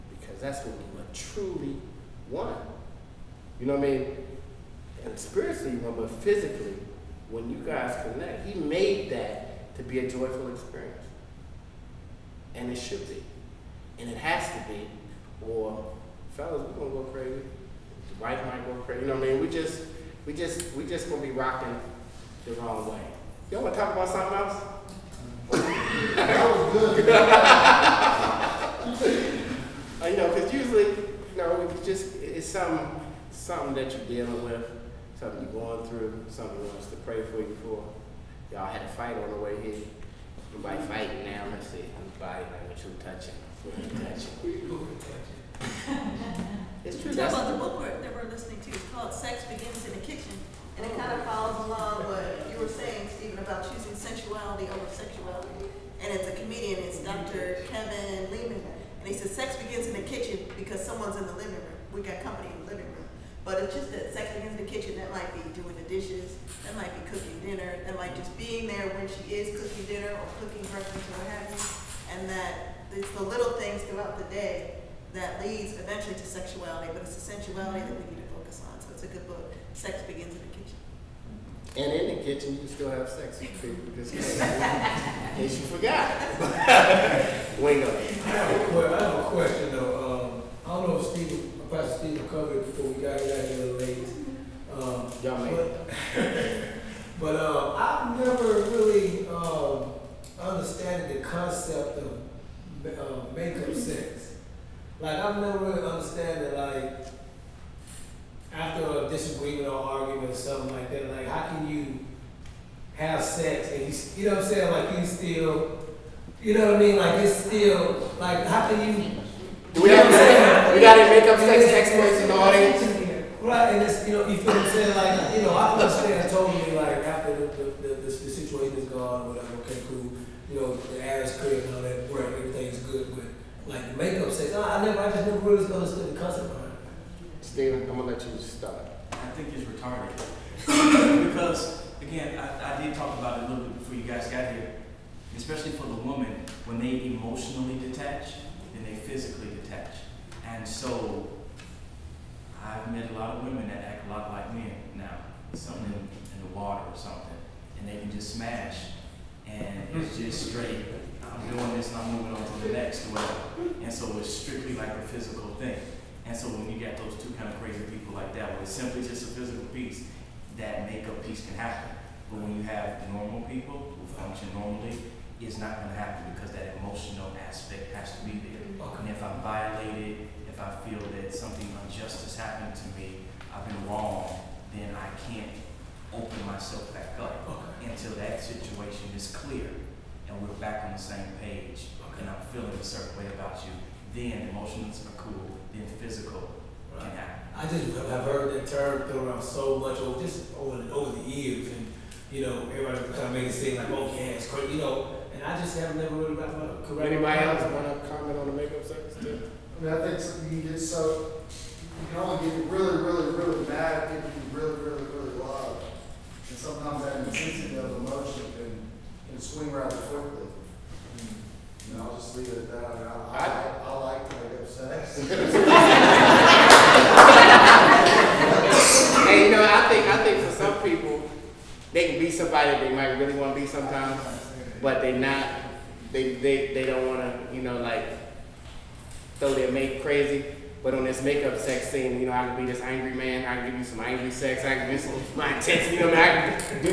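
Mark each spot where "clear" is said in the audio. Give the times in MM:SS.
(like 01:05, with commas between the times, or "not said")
02:11, 03:09.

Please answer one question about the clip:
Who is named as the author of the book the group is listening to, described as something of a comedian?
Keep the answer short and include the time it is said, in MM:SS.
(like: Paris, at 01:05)
Dr. Kevin Leman, at 00:57.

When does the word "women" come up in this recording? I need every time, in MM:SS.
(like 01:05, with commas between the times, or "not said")
02:33.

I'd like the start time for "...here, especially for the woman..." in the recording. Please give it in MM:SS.
02:24.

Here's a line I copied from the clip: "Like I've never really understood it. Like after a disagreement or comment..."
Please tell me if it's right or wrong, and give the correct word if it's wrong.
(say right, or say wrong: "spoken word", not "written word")
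wrong: "argument", not "comment".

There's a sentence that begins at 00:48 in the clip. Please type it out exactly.
It's called Sex Begins in the Kitchen.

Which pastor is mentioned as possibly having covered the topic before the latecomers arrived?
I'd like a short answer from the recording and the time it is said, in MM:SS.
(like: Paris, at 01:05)
Pastor Steve, at 01:31.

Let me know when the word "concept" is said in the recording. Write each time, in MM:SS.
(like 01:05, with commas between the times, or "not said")
01:41, 02:16.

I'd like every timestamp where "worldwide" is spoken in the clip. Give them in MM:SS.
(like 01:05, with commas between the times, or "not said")
not said.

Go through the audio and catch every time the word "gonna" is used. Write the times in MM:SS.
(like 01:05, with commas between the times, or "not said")
00:16, 00:21, 02:17.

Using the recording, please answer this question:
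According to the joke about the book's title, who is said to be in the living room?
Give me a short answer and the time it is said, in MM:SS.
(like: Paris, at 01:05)
Company, at 01:02.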